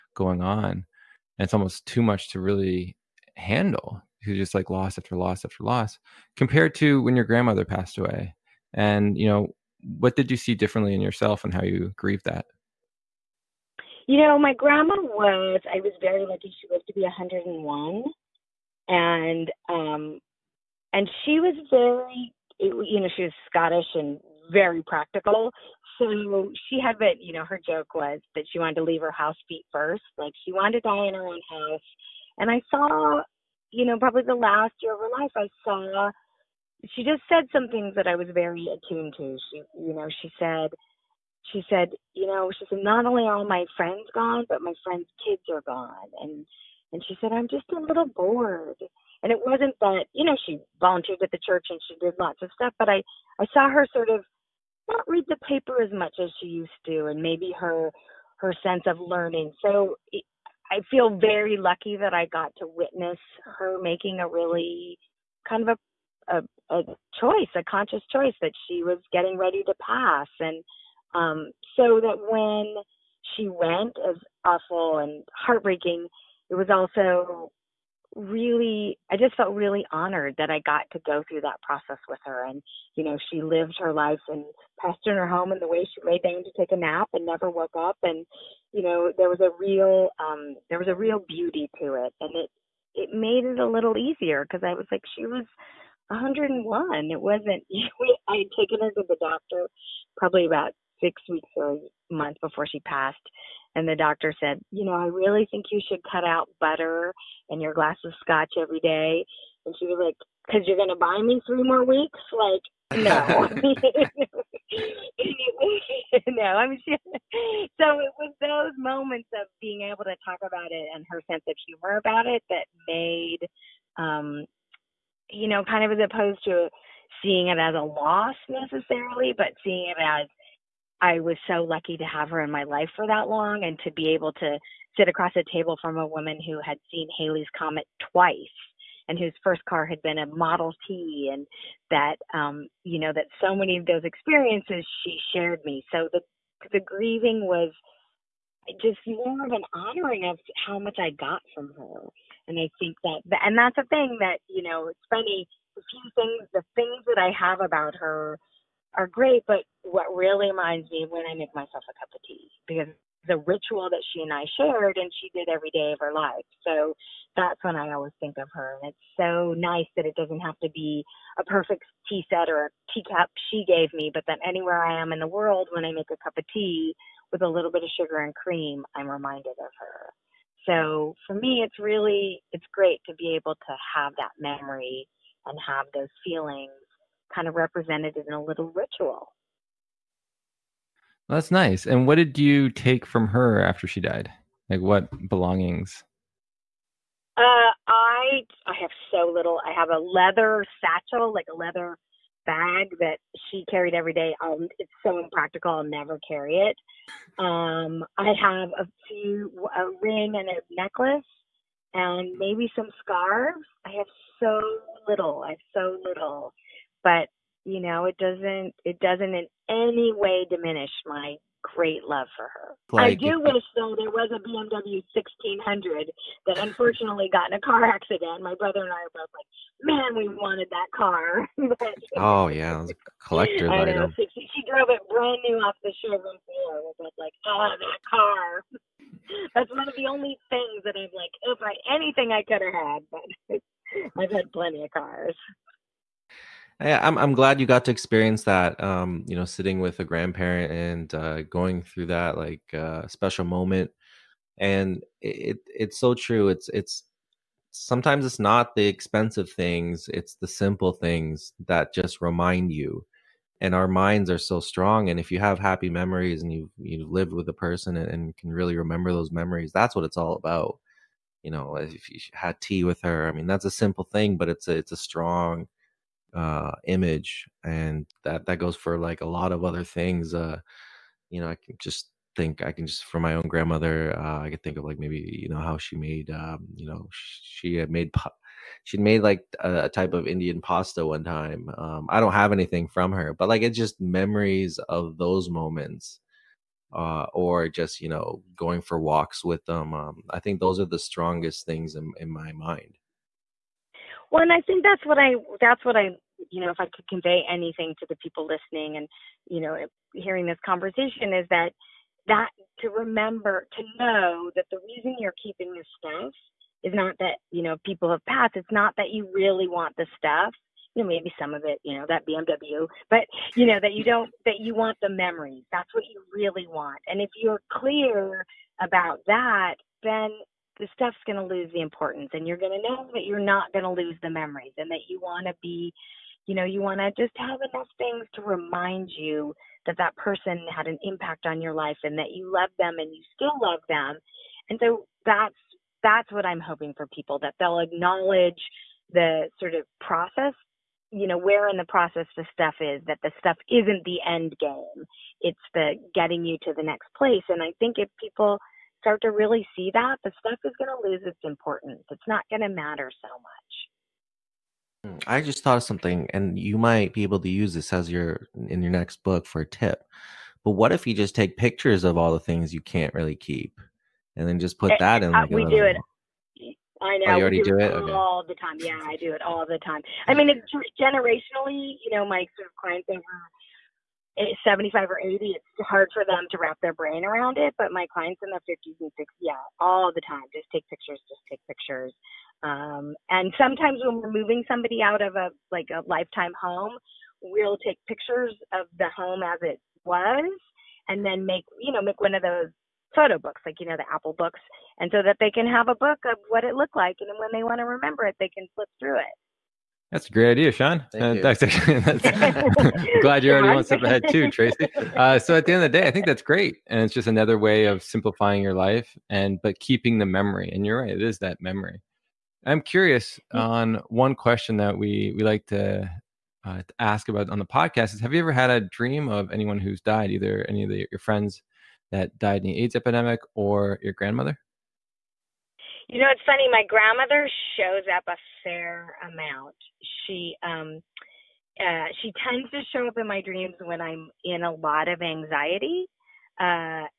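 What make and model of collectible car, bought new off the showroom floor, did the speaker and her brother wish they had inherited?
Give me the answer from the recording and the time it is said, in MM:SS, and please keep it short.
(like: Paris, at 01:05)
BMW 1600, at 03:44.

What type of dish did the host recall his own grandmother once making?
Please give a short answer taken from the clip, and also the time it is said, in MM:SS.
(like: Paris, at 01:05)
Indian pasta, at 04:50.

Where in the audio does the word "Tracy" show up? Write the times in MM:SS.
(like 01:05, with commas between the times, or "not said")
06:54.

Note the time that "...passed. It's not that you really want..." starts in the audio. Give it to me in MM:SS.
05:18.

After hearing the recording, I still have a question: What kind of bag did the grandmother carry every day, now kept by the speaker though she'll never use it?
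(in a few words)
Leather satchel.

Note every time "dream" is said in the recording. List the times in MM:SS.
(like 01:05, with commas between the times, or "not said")
07:08, 07:23.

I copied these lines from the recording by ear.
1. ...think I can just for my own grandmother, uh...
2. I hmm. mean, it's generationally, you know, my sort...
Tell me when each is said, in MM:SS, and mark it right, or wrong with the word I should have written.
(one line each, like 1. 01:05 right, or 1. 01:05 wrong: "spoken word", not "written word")
1. 04:42 right
2. 06:20 right.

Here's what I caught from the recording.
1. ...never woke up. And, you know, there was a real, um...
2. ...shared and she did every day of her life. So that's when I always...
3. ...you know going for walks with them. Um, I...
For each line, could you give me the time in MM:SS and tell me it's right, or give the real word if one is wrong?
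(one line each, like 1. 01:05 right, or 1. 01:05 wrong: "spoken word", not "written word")
1. 01:27 right
2. 02:44 right
3. 04:58 right.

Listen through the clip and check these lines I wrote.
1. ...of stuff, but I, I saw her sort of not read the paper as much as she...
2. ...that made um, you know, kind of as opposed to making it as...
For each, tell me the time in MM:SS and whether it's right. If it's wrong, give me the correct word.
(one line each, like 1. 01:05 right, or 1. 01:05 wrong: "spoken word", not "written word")
1. 00:52 right
2. 02:02 wrong: "seeing", not "making".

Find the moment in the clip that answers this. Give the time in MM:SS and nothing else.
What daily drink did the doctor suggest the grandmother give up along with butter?
01:48.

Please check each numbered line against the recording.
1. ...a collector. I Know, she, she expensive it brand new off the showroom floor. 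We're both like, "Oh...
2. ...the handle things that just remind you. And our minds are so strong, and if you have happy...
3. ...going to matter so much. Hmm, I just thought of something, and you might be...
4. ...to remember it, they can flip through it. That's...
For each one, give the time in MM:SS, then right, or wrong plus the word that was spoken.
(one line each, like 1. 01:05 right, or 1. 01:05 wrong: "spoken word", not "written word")
1. 03:52 wrong: "drove", not "expensive"
2. 04:20 wrong: "simple", not "handle"
3. 06:02 right
4. 06:47 right.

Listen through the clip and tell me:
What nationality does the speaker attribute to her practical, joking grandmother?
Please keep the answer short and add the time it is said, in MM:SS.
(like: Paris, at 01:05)
Scottish, at 00:23.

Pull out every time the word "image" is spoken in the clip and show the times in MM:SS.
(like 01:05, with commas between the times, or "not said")
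04:36.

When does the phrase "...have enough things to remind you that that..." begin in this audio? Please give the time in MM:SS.
05:37.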